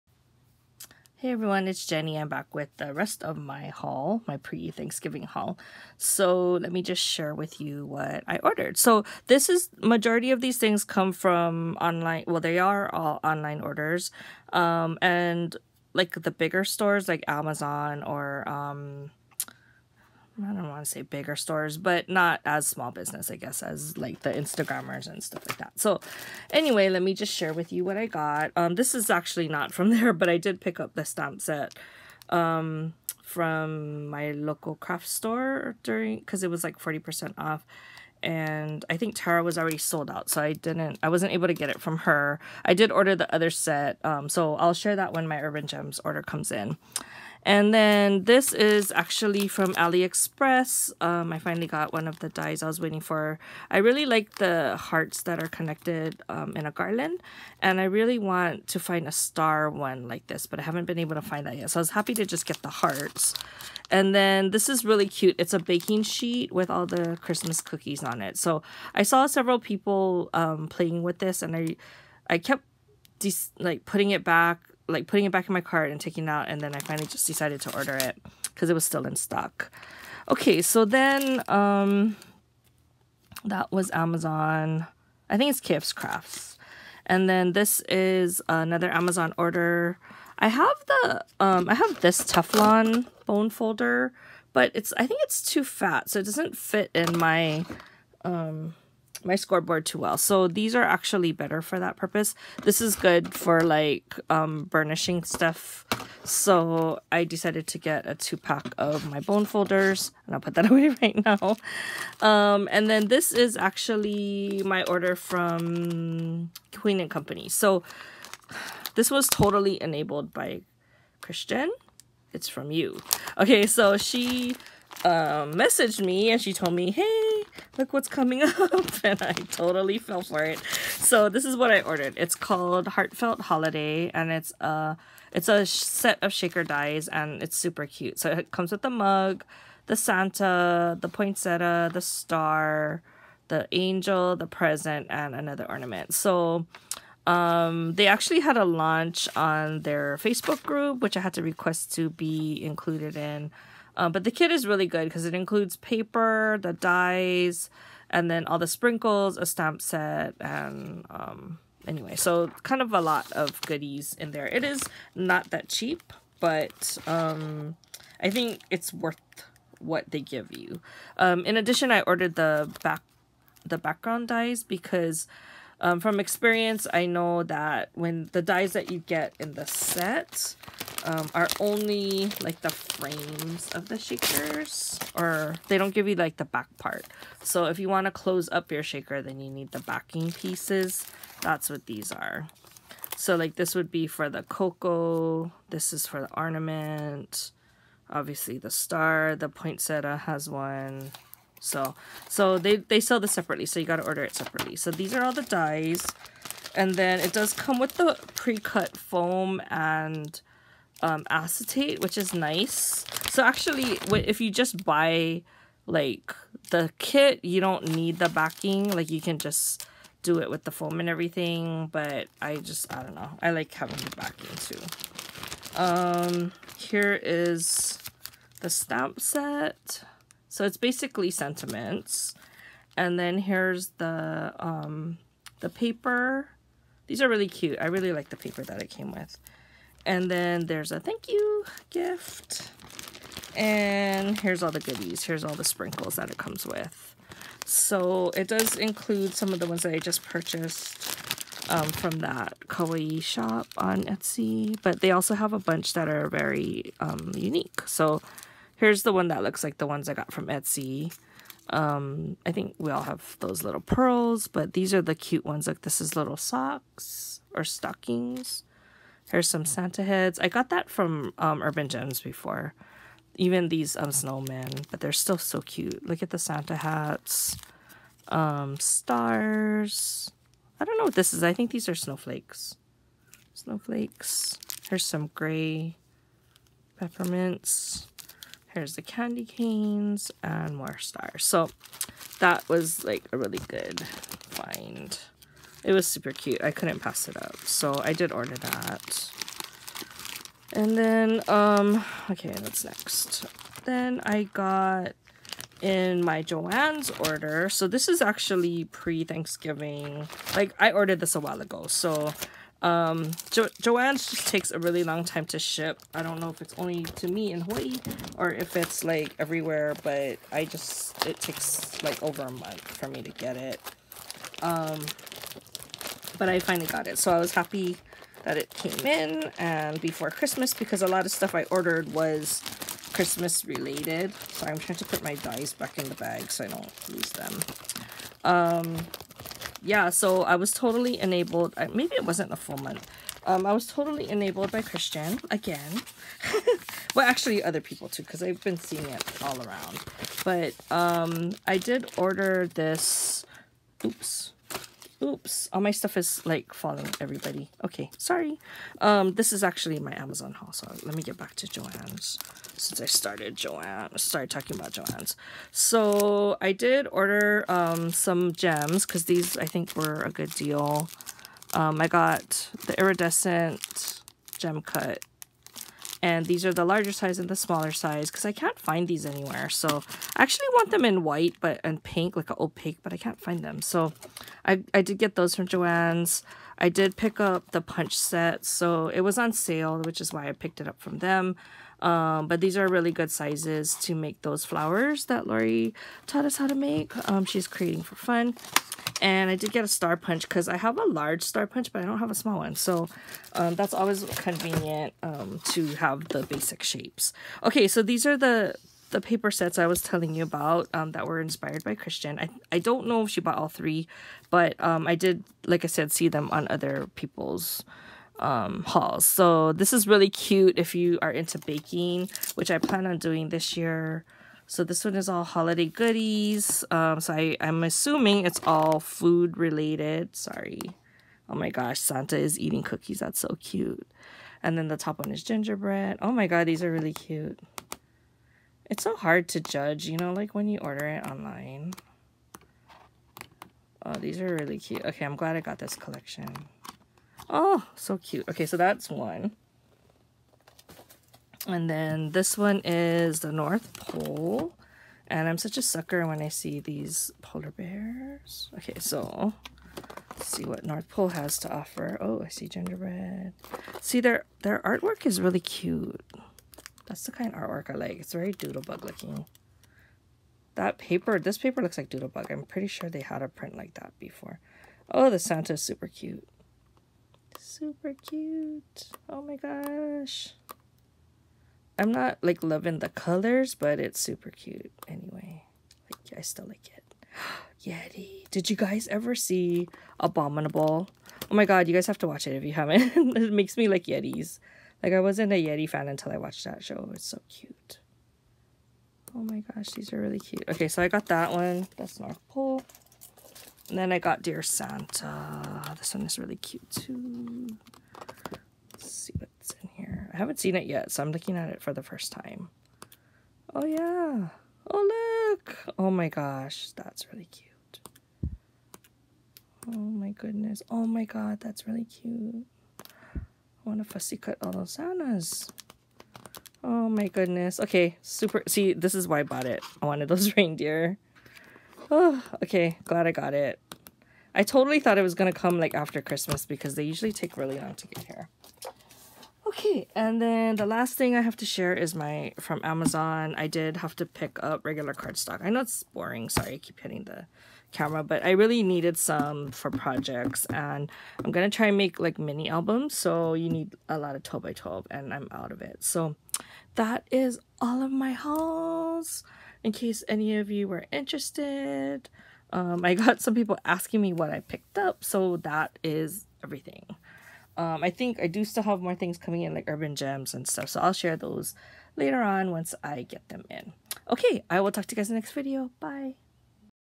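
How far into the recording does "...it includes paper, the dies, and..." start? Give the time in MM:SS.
02:35.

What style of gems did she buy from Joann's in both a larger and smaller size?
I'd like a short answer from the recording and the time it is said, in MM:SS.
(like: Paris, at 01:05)
iridescent gem cut, at 06:12.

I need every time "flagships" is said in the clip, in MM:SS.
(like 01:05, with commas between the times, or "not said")
not said.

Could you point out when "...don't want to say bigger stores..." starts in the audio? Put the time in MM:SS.
00:20.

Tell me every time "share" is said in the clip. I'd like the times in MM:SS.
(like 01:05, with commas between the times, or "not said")
00:06, 00:27, 00:44, 09:01, 09:31.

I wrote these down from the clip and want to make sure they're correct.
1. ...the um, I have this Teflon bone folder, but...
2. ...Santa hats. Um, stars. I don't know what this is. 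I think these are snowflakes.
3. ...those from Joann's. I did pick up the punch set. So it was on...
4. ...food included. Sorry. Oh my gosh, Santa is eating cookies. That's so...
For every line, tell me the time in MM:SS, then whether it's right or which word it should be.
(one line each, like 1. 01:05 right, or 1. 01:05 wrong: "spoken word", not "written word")
1. 01:30 right
2. 04:36 right
3. 06:25 right
4. 07:09 wrong: "related", not "included".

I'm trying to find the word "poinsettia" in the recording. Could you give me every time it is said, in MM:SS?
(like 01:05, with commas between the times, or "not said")
02:21, 03:19.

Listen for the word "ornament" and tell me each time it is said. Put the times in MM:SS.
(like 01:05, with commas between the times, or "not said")
02:25, 03:16.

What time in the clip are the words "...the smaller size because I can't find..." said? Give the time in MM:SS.
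06:17.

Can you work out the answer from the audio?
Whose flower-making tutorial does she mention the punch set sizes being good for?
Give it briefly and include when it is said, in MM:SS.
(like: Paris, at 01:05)
Lori, at 06:35.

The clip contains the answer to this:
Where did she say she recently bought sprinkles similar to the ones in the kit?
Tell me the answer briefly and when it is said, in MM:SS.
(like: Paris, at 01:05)
kawaii shop on Etsy, at 04:12.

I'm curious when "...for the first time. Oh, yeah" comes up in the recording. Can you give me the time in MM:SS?
08:31.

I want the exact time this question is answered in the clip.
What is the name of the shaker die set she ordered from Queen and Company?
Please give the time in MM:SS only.
02:12.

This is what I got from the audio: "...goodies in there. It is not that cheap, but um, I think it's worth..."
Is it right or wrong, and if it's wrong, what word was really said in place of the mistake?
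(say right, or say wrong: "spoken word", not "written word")
right.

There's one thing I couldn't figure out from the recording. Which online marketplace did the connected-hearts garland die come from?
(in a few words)
AliExpress.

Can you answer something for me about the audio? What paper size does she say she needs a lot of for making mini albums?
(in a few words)
12 by 12.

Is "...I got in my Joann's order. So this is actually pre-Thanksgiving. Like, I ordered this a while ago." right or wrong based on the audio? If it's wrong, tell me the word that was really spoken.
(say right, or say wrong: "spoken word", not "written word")
right.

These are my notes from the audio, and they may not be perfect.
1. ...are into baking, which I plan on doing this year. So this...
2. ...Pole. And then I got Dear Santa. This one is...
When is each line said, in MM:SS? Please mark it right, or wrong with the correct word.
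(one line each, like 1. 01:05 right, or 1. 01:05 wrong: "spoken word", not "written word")
1. 07:01 right
2. 08:22 right.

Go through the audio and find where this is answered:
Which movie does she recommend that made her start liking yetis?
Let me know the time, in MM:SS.
08:10.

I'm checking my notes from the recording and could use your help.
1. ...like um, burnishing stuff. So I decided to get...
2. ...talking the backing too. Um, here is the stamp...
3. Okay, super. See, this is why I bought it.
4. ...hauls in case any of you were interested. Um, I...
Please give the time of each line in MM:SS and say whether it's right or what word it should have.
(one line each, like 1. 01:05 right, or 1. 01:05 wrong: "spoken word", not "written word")
1. 01:43 right
2. 03:43 wrong: "having", not "talking"
3. 08:47 right
4. 09:18 right.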